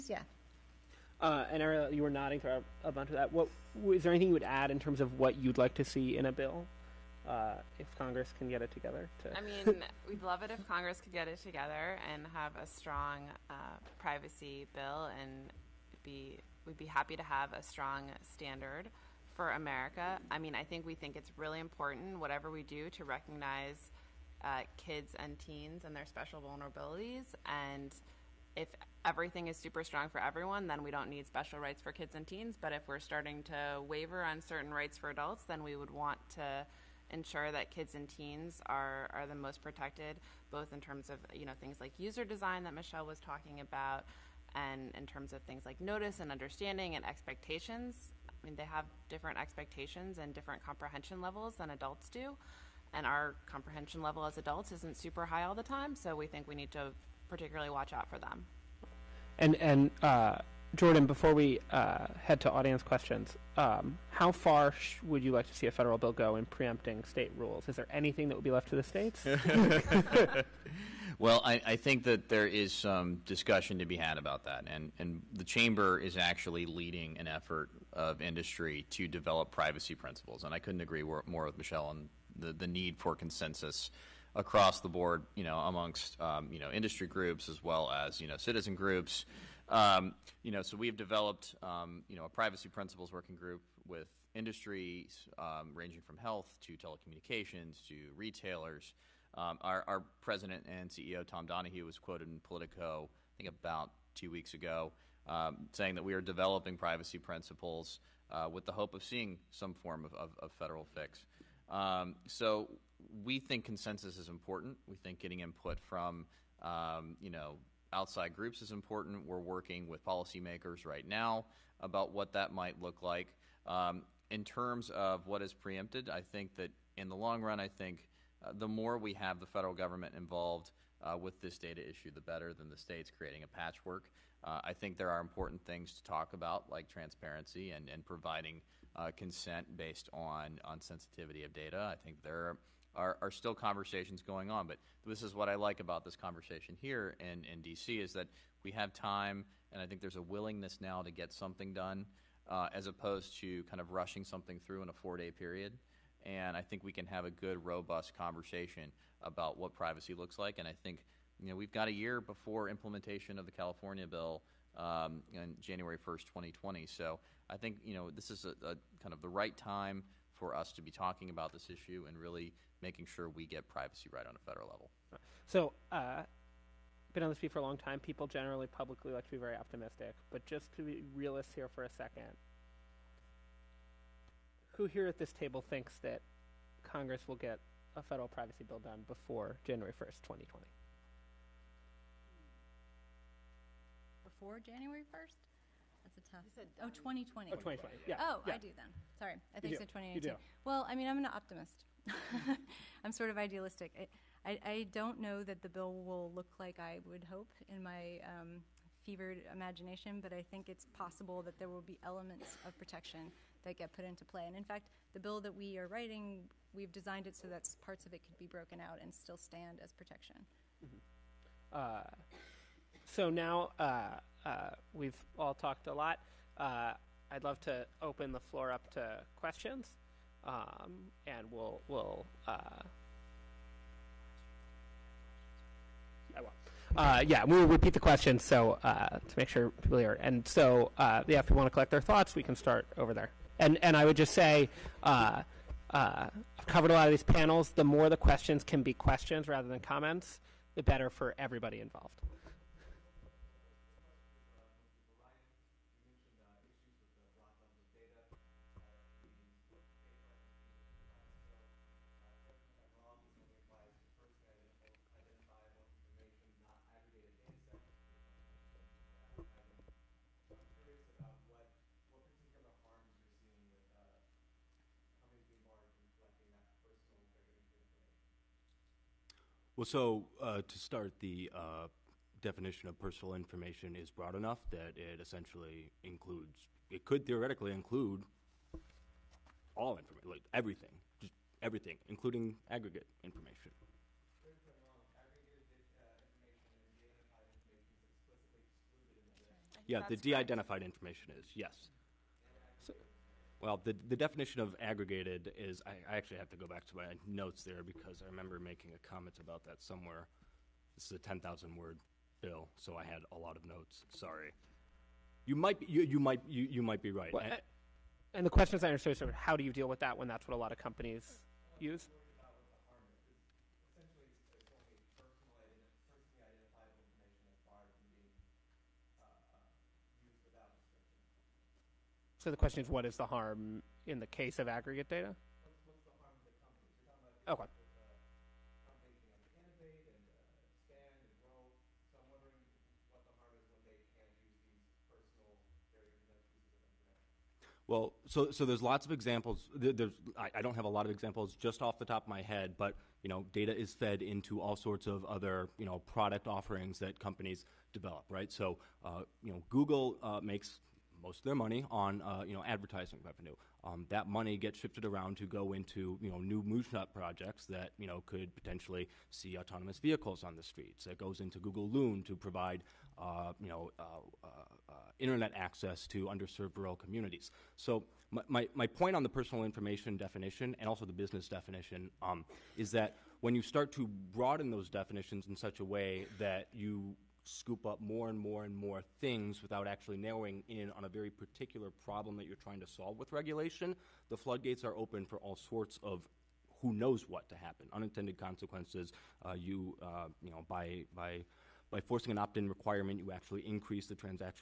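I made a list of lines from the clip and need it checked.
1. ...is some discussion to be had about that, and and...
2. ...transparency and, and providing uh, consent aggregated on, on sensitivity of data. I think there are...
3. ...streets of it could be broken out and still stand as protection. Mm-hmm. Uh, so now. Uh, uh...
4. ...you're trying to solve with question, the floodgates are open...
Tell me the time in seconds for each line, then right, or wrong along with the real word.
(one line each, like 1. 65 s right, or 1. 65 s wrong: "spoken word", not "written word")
1. 72 s right
2. 136 s wrong: "based", not "aggregated"
3. 217 s wrong: "parts", not "streets"
4. 392 s wrong: "regulation", not "question".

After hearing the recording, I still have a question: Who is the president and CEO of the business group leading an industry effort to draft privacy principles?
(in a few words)
Tom Donohue.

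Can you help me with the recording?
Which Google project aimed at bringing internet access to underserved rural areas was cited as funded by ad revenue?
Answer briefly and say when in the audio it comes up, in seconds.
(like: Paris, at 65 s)
Google Loon, at 371 s.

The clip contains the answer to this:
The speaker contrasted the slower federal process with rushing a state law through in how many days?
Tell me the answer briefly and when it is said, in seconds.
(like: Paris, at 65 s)
4, at 154 s.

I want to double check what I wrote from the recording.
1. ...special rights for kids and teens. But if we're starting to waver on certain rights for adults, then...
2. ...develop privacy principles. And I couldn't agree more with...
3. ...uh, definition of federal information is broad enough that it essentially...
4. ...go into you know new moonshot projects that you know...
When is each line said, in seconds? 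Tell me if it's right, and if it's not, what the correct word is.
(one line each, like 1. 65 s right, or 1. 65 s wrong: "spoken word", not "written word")
1. 31 s right
2. 79 s right
3. 281 s wrong: "personal", not "federal"
4. 365 s right.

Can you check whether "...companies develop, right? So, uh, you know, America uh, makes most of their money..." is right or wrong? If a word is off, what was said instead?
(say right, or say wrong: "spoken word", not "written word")
wrong: "Google", not "America".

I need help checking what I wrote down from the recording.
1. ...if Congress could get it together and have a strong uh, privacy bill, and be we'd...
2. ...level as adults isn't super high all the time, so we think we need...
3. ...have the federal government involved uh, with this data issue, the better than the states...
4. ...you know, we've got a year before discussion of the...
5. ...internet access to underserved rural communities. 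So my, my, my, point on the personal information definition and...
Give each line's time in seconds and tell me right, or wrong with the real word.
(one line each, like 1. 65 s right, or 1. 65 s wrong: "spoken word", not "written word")
1. 10 s right
2. 54 s right
3. 129 s right
4. 161 s wrong: "implementation", not "discussion"
5. 375 s right.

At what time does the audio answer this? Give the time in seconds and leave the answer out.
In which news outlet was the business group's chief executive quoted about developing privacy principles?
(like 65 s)
102 s.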